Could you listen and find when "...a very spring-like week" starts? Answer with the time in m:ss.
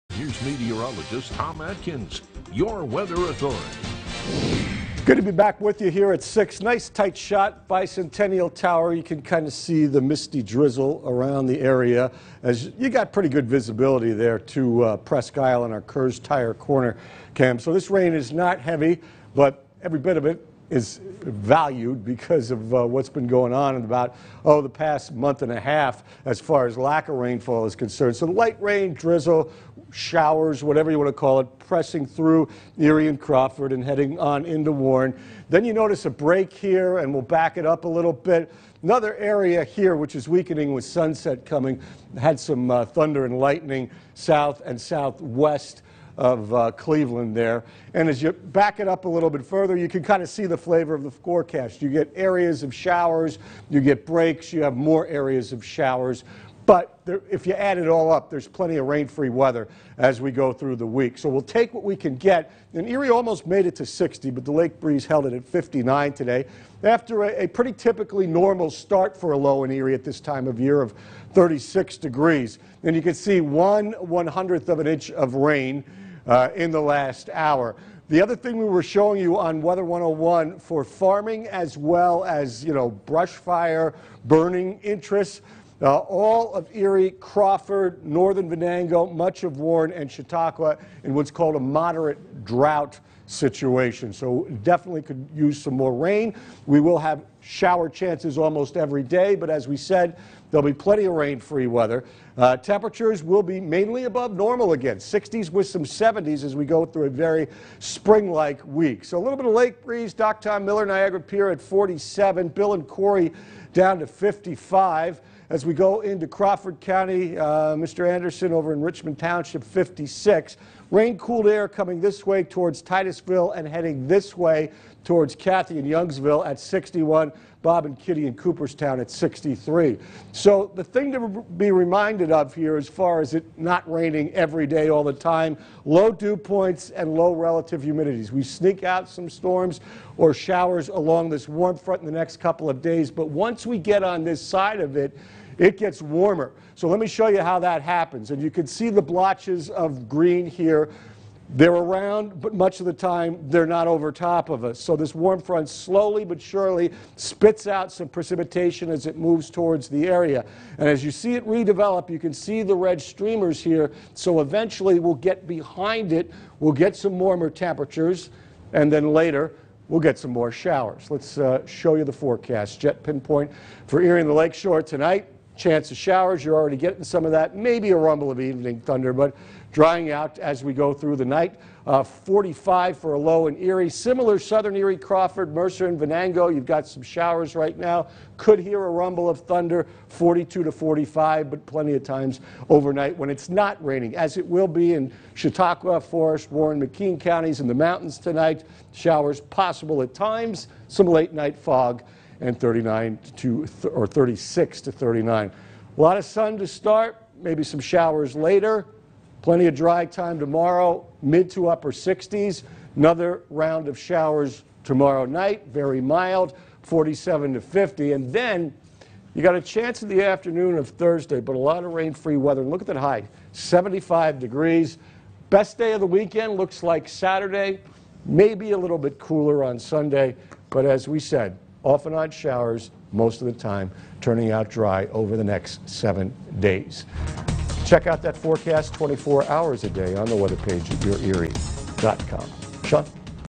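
1:47.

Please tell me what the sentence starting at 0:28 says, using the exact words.
So light rain, drizzle, showers, whatever you want to call it, pressing through Erie and Crawford and heading on into Warren.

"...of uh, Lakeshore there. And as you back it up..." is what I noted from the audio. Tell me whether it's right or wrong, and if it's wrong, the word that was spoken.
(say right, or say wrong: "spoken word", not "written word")
wrong: "Cleveland", not "Lakeshore".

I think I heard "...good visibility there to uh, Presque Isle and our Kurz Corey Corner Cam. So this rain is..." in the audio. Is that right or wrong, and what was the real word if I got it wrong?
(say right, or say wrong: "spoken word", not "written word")
wrong: "Tire", not "Corey".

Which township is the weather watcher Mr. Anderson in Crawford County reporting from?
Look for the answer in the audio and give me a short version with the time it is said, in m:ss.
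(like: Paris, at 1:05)
Richmond Township, at 1:58.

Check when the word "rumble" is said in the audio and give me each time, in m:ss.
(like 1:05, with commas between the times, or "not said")
2:57, 3:08.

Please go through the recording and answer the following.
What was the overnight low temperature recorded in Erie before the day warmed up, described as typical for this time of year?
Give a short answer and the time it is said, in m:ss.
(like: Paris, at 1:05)
36 degrees, at 1:11.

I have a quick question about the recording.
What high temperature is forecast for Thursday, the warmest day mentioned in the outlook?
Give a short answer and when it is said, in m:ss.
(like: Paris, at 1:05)
75 degrees, at 3:43.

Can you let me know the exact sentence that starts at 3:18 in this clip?
Showers possible at times, some late night fog and 39 to th or 36 to 39.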